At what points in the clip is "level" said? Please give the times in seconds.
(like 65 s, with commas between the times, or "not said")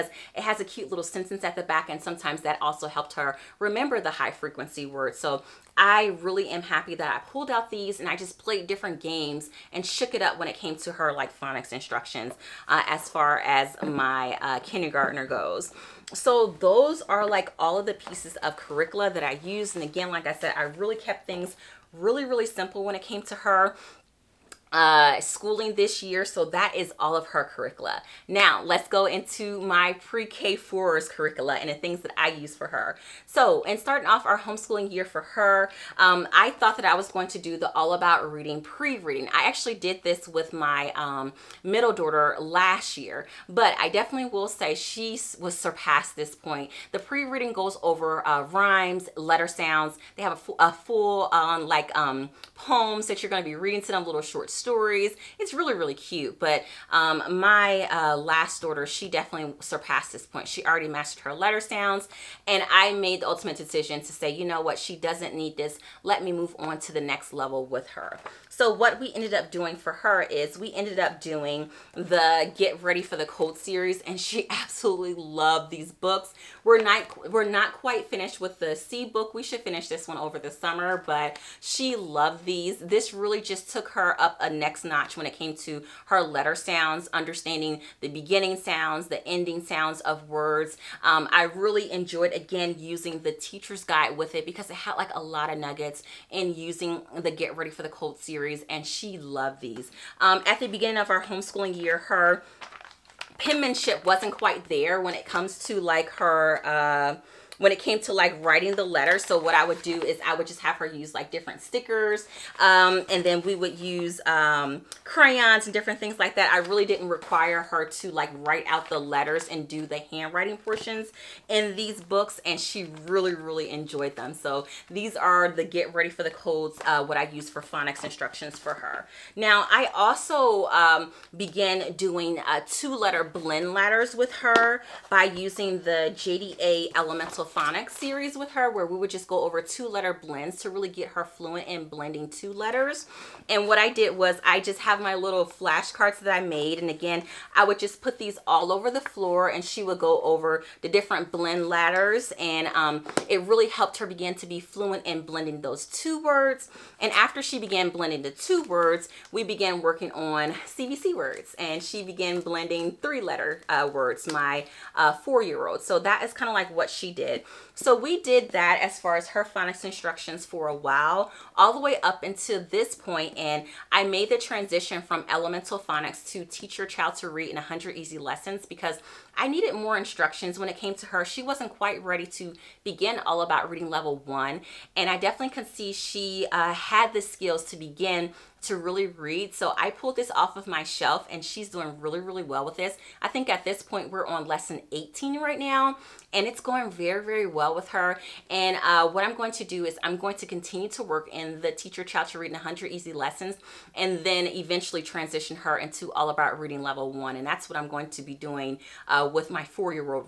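67 s, 183 s, 206 s.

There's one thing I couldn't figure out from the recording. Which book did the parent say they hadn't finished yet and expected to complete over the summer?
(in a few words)
C book.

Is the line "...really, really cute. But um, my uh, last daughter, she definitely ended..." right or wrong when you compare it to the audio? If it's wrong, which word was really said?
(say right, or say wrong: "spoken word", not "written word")
wrong: "surpassed", not "ended".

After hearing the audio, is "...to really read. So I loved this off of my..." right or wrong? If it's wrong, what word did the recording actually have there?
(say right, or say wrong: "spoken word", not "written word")
wrong: "pulled", not "loved".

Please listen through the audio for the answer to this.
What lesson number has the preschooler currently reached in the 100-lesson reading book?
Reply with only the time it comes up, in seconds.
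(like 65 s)
194 s.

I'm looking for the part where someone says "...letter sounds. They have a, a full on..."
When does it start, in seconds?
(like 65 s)
49 s.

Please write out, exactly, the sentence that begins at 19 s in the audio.
And again, like I said, I really kept things really, really simple when it came to her uh, schooling this year.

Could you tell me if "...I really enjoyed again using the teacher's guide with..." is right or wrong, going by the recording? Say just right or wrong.
right.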